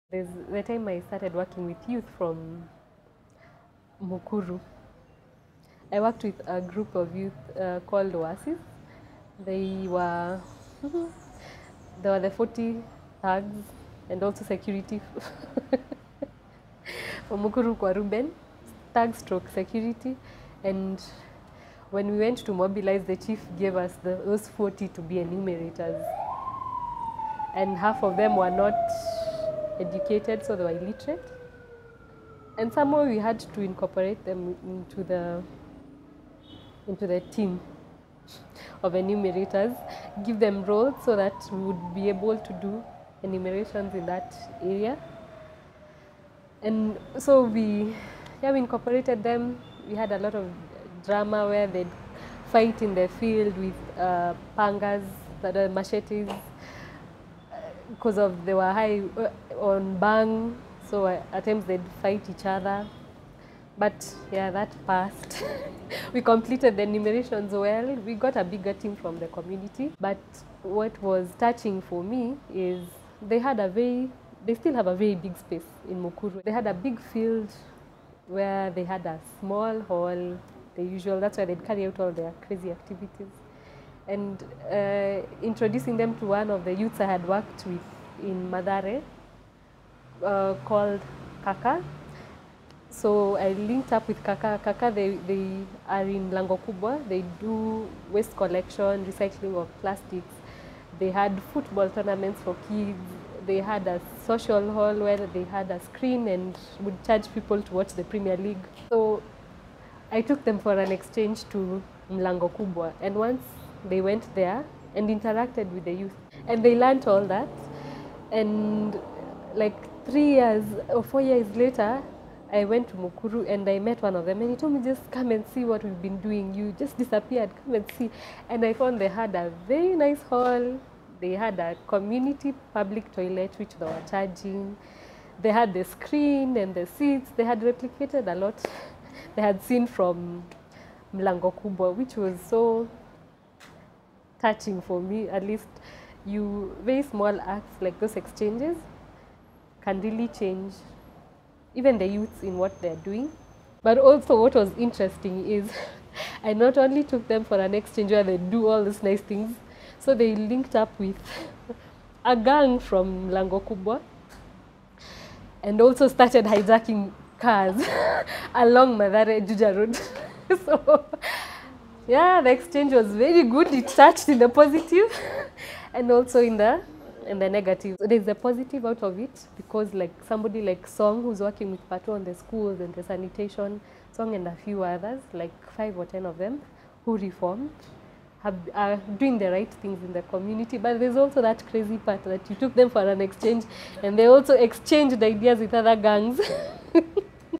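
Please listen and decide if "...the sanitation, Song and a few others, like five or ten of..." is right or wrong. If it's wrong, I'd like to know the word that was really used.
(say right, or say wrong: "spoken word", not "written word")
right.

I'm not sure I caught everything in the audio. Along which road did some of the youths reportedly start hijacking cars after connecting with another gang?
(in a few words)
Mathare Juja Road.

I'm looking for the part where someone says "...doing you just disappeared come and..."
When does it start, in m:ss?
2:06.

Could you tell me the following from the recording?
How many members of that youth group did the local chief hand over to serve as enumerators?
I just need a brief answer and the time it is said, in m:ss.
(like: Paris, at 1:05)
40, at 0:24.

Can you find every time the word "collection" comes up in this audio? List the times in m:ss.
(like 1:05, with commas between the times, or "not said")
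1:38.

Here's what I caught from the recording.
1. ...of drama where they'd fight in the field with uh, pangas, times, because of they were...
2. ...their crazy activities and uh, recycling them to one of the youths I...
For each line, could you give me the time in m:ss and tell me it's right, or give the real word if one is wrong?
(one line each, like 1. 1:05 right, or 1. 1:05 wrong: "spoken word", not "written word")
1. 0:50 wrong: "machetes", not "times"
2. 1:22 wrong: "introducing", not "recycling".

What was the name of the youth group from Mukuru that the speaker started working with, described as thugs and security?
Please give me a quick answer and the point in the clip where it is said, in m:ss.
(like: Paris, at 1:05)
Oasis, at 0:08.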